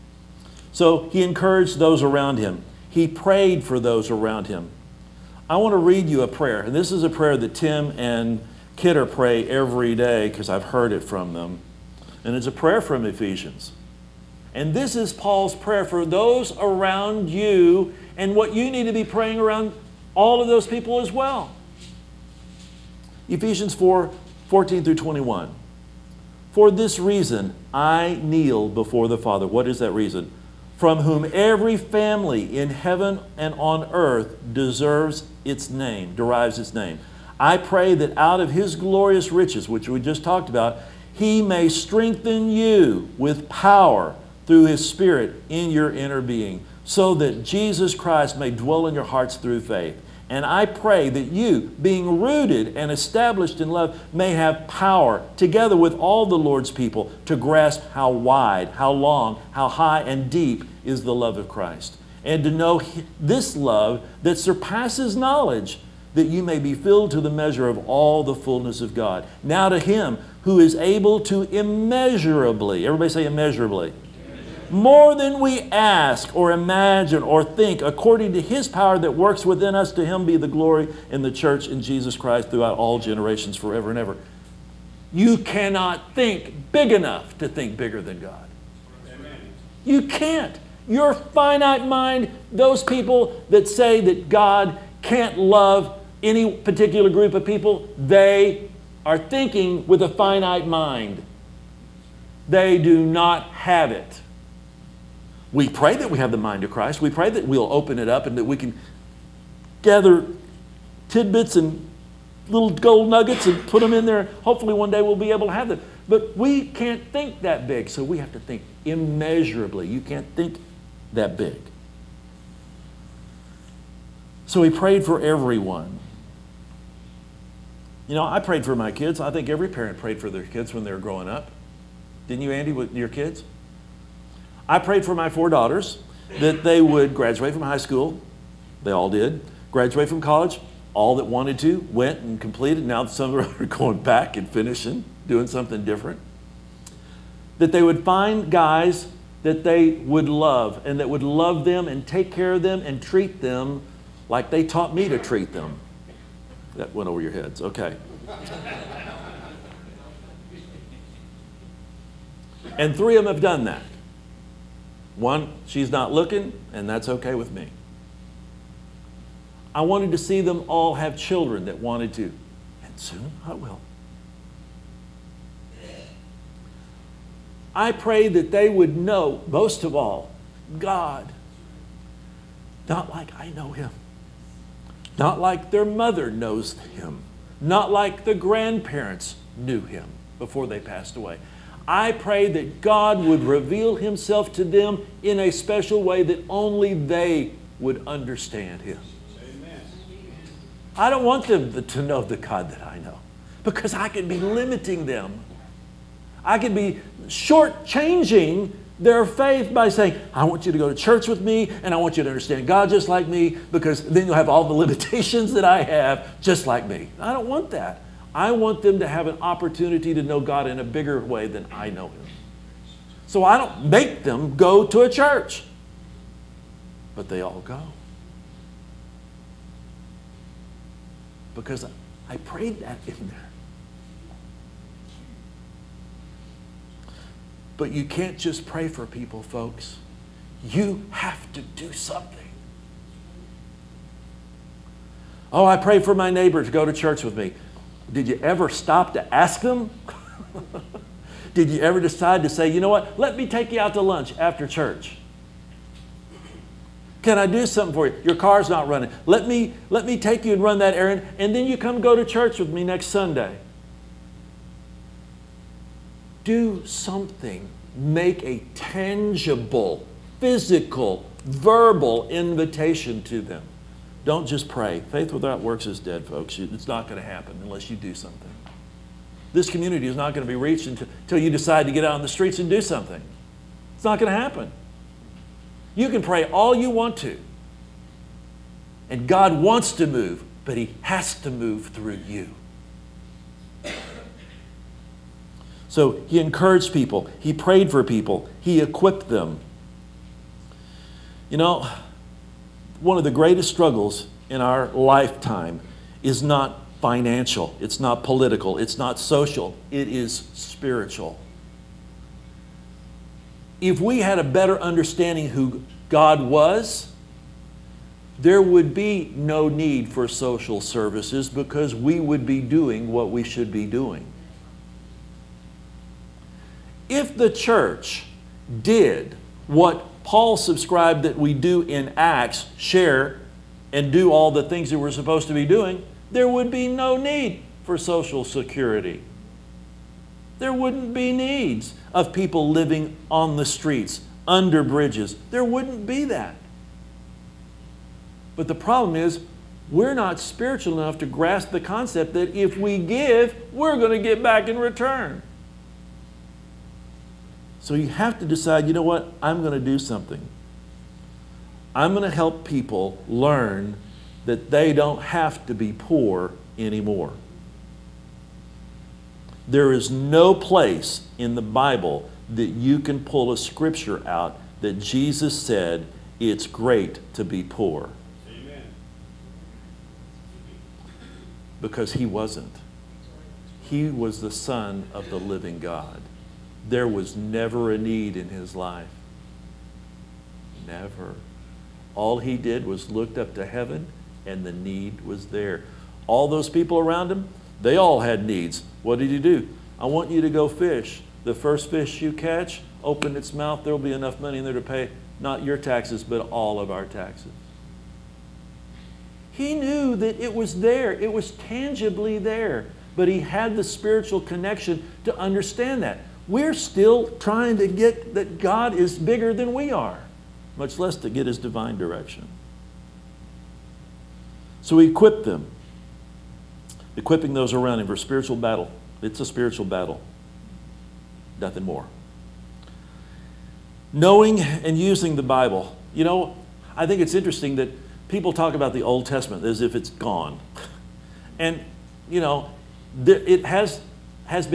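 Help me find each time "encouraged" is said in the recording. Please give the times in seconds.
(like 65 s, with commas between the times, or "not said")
1 s, 296 s.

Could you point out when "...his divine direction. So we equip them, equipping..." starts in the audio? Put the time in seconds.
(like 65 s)
421 s.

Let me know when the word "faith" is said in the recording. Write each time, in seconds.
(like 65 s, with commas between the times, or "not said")
49 s, 209 s, 275 s.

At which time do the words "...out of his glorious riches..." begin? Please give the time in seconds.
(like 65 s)
38 s.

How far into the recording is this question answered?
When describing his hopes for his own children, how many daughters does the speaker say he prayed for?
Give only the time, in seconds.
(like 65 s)
135 s.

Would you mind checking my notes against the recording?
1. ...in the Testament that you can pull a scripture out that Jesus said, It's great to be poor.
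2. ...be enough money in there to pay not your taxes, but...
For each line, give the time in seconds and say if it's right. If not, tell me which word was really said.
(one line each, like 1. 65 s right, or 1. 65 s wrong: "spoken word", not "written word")
1. 371 s wrong: "Bible", not "Testament"
2. 403 s right.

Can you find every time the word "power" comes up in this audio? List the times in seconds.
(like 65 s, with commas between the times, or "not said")
43 s, 54 s, 78 s.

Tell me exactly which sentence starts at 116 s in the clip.
But we can't think that big, so we have to think immeasurably.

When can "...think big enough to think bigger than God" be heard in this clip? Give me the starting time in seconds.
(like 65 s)
86 s.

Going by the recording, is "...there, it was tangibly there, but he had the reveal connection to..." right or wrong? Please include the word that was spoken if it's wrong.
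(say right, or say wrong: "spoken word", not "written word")
wrong: "spiritual", not "reveal".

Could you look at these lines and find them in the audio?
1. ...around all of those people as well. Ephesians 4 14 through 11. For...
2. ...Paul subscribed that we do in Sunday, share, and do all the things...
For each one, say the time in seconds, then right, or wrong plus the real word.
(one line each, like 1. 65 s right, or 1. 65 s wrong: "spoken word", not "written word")
1. 19 s wrong: "21", not "11"
2. 330 s wrong: "Acts", not "Sunday".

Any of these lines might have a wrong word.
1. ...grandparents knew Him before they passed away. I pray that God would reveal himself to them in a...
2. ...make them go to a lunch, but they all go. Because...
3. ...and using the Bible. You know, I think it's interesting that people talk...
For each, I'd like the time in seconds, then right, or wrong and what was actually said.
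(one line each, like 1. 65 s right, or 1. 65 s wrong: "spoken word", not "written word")
1. 188 s right
2. 223 s wrong: "church", not "lunch"
3. 434 s right.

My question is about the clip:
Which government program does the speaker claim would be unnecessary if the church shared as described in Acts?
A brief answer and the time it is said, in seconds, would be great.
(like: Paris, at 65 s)
Social Security, at 337 s.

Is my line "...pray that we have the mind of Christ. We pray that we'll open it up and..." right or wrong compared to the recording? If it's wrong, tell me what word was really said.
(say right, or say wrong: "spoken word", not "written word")
right.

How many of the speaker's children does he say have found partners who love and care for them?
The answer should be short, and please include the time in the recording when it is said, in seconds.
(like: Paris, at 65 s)
3, at 162 s.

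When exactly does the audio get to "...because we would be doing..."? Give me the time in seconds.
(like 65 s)
321 s.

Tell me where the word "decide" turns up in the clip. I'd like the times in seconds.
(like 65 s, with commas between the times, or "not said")
252 s, 281 s, 358 s.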